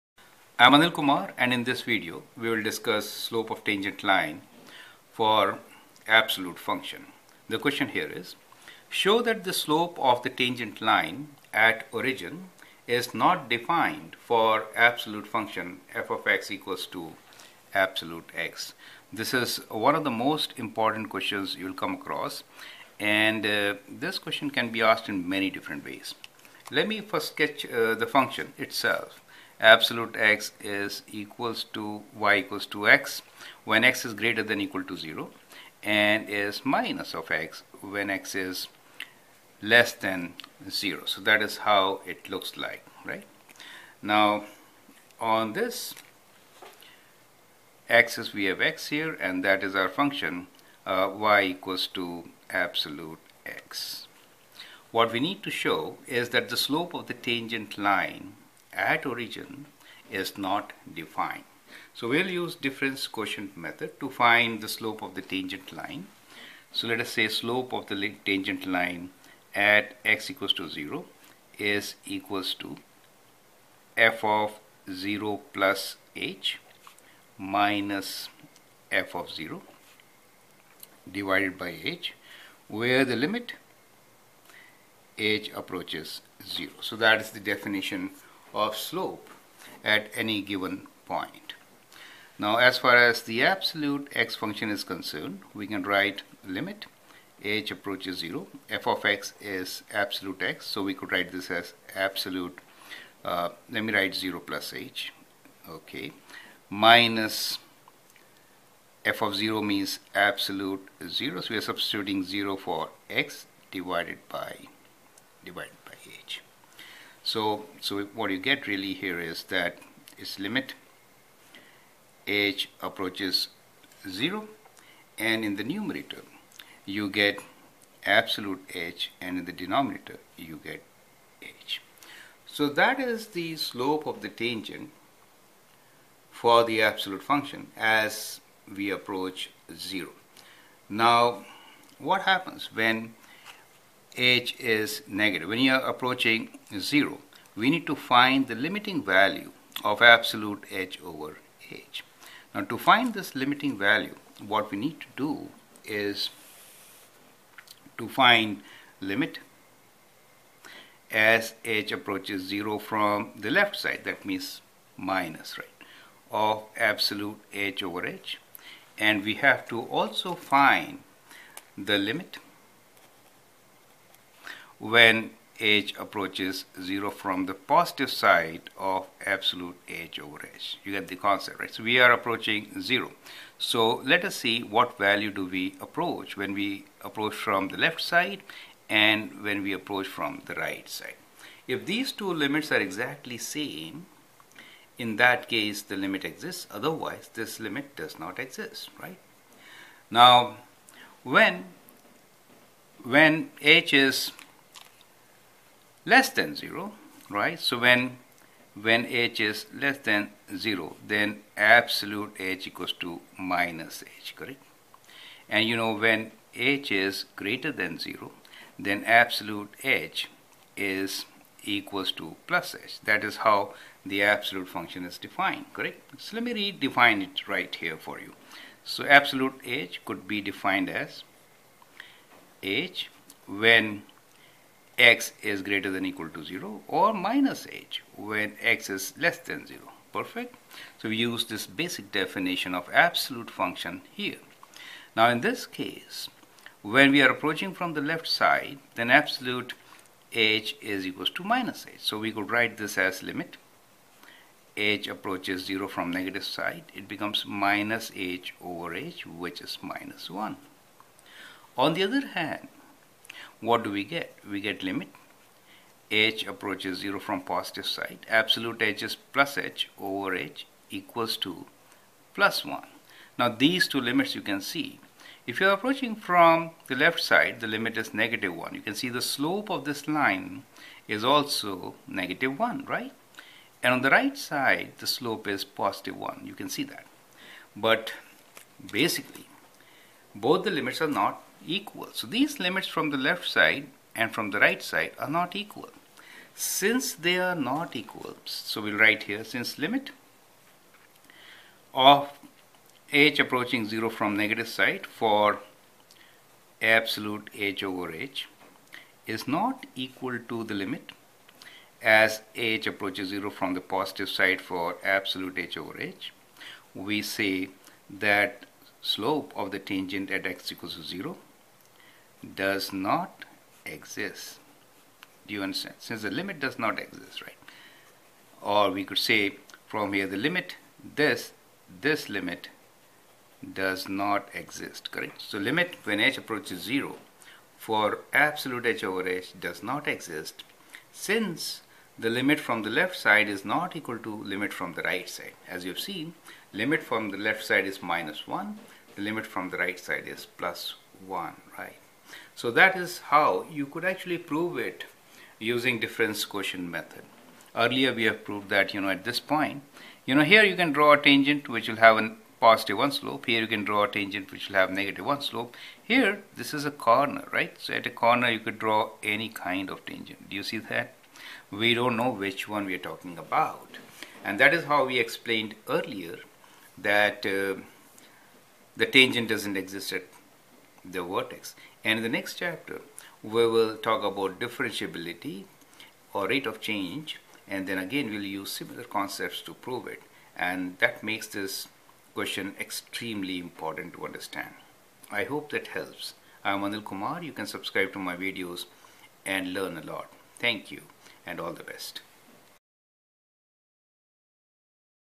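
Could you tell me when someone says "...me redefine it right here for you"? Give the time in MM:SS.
03:46.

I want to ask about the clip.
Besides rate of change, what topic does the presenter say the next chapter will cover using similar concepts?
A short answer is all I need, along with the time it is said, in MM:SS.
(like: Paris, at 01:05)
differentiability, at 06:24.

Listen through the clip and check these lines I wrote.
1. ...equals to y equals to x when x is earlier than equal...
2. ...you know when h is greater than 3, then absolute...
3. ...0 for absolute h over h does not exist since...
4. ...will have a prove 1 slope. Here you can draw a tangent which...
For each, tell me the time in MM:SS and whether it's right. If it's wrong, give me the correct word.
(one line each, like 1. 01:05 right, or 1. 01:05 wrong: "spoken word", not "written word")
1. 00:31 wrong: "greater", not "earlier"
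2. 03:35 wrong: "0", not "3"
3. 05:36 right
4. 06:01 wrong: "positive", not "prove".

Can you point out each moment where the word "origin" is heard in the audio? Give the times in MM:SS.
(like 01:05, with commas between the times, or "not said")
00:11, 00:59.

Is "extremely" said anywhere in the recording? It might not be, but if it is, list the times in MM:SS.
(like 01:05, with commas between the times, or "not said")
06:32.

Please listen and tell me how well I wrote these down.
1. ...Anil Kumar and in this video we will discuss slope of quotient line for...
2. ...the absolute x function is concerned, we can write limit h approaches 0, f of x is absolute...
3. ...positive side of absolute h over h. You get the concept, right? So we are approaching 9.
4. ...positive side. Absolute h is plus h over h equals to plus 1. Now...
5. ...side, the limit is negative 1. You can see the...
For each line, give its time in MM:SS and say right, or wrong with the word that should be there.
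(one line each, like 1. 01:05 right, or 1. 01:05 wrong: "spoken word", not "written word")
1. 00:00 wrong: "tangent", not "quotient"
2. 01:33 right
3. 02:57 wrong: "0", not "9"
4. 04:27 right
5. 04:37 right.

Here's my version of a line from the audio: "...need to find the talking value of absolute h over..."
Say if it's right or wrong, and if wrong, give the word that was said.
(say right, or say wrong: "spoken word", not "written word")
wrong: "limiting", not "talking".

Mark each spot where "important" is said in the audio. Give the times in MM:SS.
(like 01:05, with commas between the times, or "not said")
00:20, 06:33.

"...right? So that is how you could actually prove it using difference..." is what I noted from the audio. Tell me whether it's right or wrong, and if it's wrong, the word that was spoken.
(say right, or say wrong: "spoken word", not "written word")
right.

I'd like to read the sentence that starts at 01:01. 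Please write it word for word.
So we'll use difference quotient method to find the slope of the tangent line.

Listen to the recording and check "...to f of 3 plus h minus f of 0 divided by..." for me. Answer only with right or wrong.
wrong.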